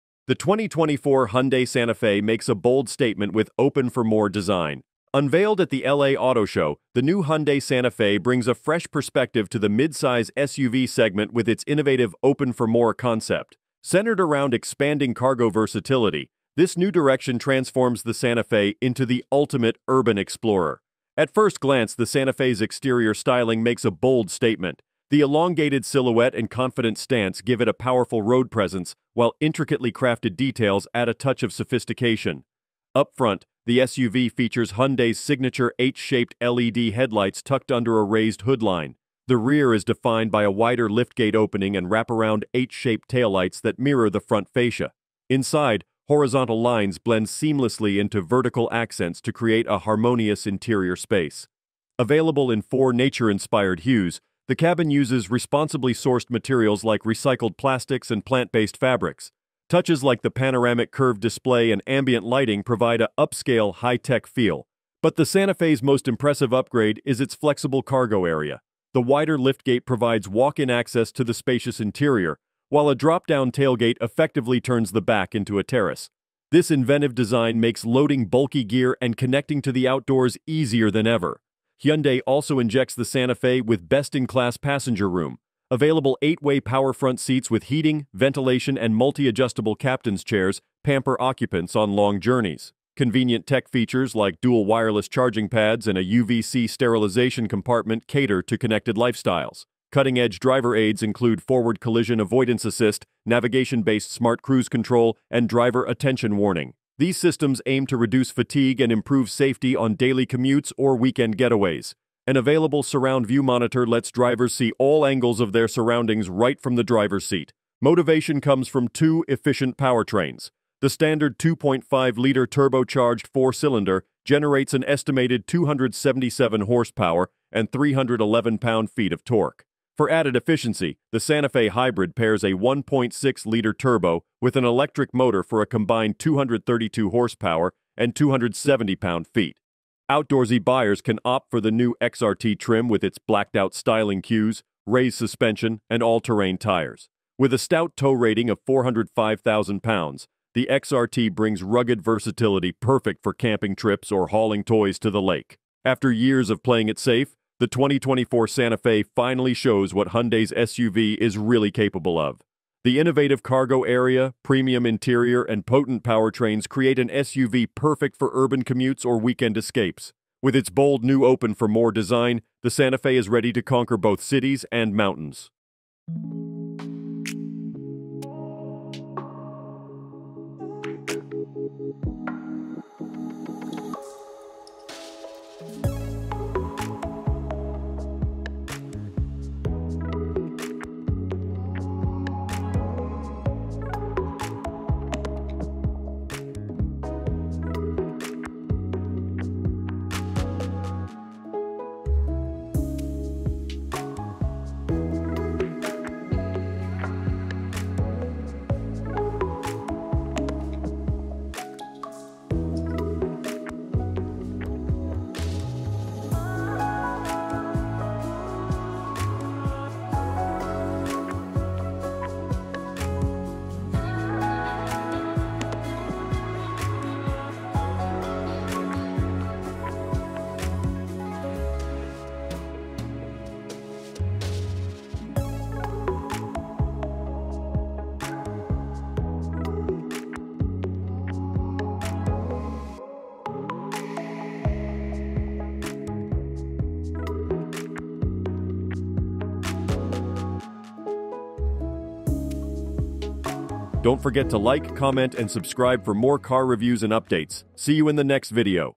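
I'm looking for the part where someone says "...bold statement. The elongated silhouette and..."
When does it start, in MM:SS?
00:23.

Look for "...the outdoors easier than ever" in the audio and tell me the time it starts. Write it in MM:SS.
01:19.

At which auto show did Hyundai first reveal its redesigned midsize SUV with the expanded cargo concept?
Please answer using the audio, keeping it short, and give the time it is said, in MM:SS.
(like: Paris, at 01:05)
LA Auto Show, at 00:05.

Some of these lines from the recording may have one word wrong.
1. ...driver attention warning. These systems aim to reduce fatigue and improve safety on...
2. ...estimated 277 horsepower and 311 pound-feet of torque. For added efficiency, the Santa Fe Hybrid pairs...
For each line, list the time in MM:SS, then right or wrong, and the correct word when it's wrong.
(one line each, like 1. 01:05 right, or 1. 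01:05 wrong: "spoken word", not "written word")
1. 01:45 right
2. 02:04 right.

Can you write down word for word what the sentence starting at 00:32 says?
Up front, the SUV features Hyundai's signature H-shaped LED headlights tucked under a raised hoodline.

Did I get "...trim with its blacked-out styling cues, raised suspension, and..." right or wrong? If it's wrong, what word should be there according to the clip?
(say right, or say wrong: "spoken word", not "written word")
right.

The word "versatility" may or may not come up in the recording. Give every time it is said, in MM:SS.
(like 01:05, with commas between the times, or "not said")
00:15, 02:32.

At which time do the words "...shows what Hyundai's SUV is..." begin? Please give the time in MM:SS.
02:39.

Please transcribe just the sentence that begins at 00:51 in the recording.
Available in four nature-inspired hues, the cabin uses responsibly sourced materials like recycled plastics and plant-based fabrics.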